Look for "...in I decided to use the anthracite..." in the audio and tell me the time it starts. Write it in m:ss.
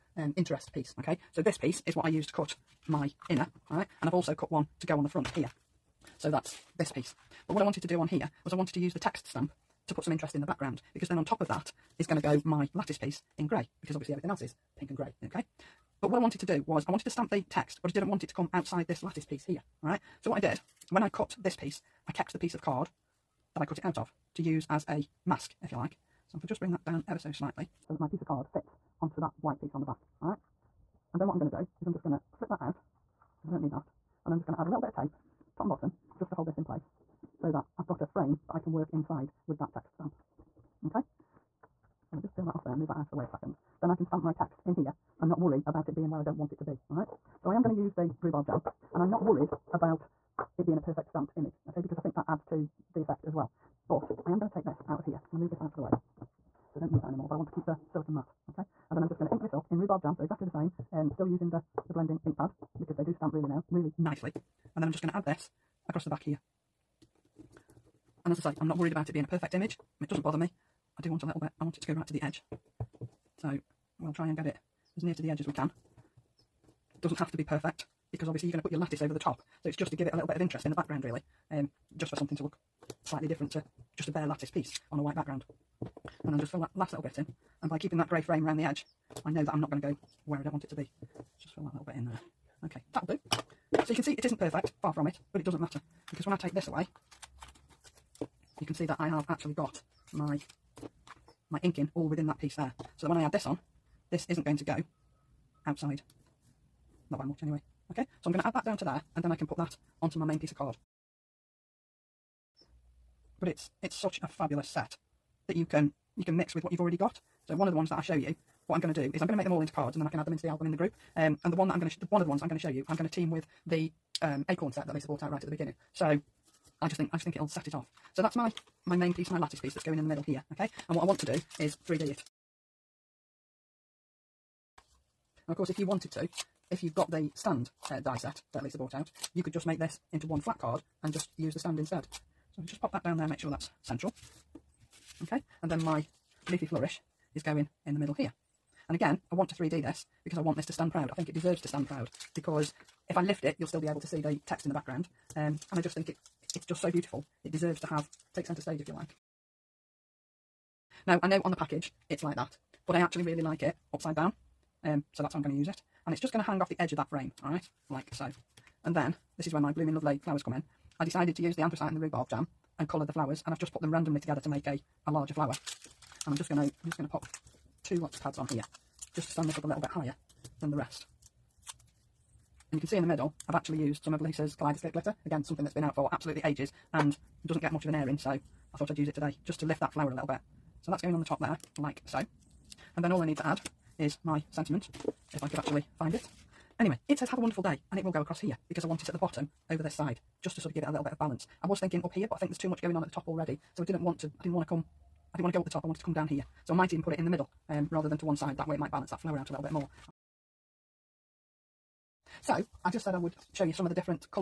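2:50.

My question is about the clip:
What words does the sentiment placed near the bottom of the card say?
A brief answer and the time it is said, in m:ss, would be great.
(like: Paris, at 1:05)
Have a wonderful day, at 3:17.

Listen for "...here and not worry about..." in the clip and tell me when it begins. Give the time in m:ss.
0:44.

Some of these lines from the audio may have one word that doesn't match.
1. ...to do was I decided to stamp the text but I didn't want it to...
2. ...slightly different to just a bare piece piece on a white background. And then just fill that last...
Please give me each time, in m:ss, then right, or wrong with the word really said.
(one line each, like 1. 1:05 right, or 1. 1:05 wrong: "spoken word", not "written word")
1. 0:16 wrong: "wanted", not "decided"
2. 1:23 wrong: "lattice", not "piece".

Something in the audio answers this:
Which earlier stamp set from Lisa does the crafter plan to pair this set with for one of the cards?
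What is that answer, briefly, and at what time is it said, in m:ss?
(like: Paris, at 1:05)
Acorn set, at 2:04.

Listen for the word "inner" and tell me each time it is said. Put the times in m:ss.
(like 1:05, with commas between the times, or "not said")
0:03.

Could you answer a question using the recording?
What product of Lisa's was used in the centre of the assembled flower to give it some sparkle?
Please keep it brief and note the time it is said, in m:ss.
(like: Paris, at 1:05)
Kaleidoscope glitter, at 3:04.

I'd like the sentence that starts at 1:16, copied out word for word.
It doesn't have to be perfect because obviously you're going to put your lattice over the top.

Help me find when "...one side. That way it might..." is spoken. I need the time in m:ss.
3:28.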